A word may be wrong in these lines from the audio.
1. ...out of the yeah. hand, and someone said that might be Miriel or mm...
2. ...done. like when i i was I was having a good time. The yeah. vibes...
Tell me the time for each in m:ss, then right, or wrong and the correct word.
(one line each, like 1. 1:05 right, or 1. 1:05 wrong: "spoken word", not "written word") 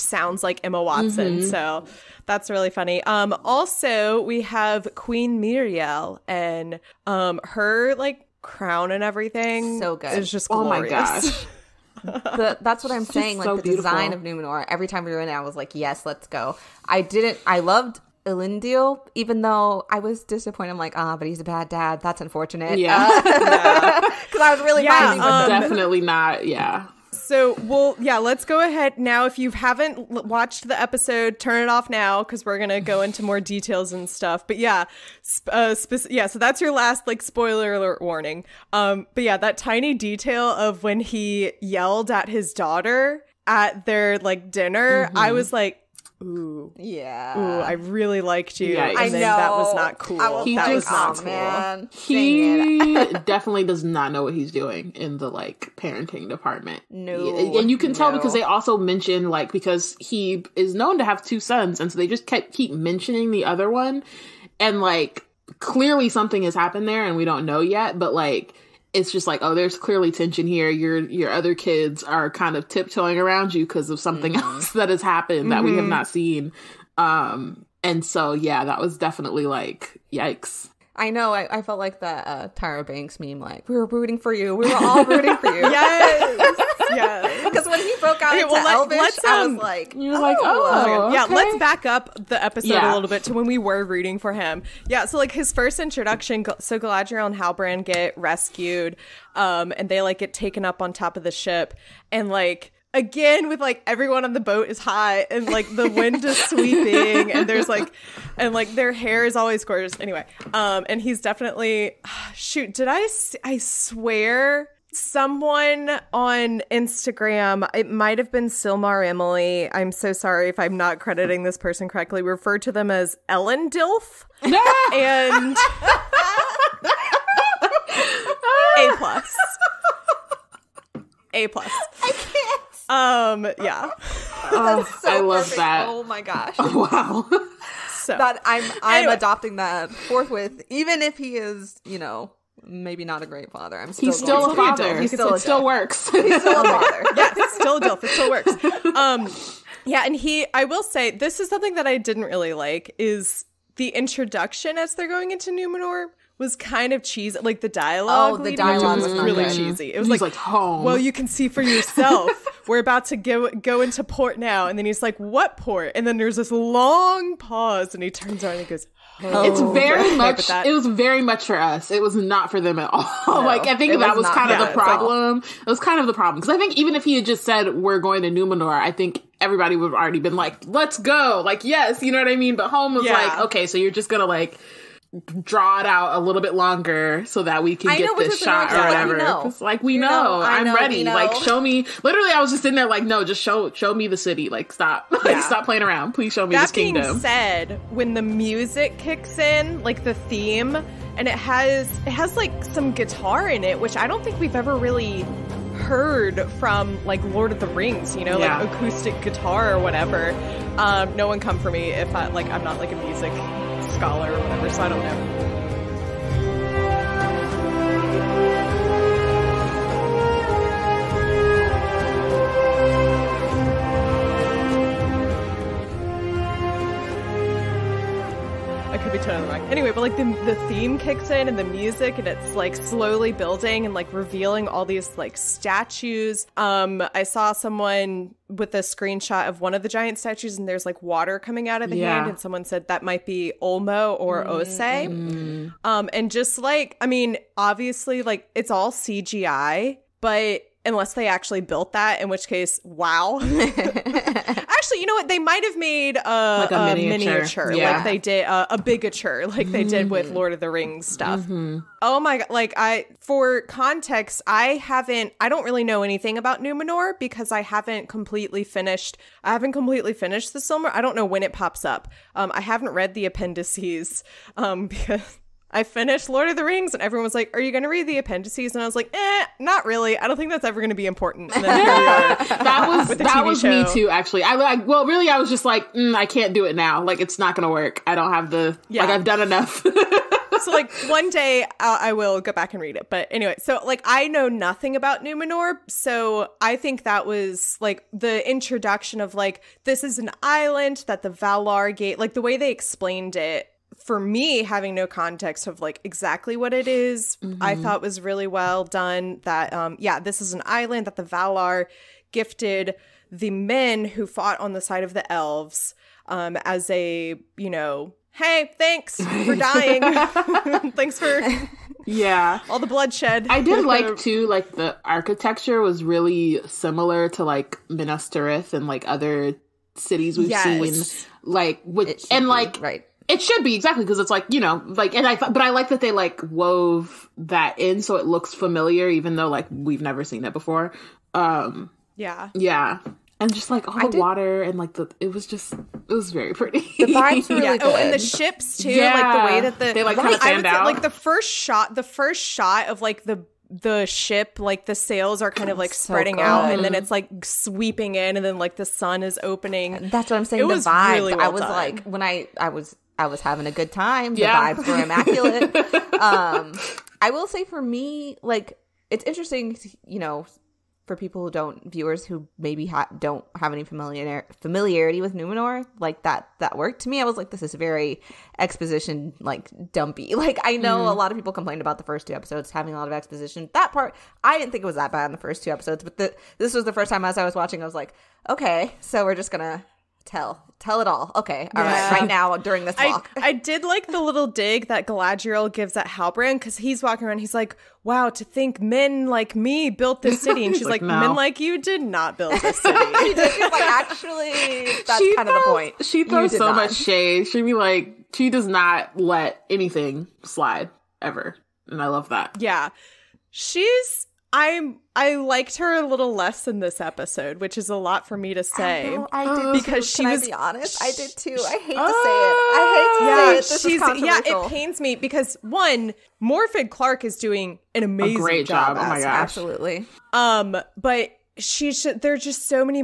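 1. 4:01 wrong: "Ulmo", not "Miriel"
2. 6:01 right.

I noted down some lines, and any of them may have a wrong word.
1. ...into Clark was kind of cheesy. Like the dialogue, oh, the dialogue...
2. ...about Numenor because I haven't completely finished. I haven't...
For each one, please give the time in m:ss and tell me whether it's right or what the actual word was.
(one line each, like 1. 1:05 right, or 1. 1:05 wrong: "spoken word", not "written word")
1. 2:35 wrong: "Numenor", not "Clark"
2. 4:26 right.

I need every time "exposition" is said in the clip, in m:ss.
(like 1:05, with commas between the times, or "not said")
6:18, 6:23.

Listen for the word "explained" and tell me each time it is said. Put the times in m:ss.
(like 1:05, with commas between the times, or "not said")
5:02.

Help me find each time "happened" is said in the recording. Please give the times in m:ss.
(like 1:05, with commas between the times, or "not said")
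1:06, 1:15.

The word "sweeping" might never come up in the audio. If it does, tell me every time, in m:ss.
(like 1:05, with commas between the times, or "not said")
1:46, 5:57.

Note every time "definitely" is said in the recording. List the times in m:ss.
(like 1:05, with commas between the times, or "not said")
0:25, 0:53, 1:18, 1:51.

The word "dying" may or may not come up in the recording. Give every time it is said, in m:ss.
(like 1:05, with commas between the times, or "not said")
5:19.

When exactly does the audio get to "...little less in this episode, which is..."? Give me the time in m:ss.
6:56.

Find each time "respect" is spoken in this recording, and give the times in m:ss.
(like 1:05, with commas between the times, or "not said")
not said.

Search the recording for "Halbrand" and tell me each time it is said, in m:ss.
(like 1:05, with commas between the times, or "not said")
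1:37, 6:36.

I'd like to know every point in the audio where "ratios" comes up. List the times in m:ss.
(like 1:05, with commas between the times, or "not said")
not said.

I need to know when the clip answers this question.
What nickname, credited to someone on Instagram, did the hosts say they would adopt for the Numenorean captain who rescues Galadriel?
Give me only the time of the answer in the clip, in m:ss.
2:03.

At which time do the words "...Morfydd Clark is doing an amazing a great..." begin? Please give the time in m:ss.
7:06.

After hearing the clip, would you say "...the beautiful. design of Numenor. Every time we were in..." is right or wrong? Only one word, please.
right.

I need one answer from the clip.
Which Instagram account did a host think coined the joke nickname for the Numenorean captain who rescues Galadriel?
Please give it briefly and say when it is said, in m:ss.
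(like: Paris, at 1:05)
Silmar Emily, at 1:58.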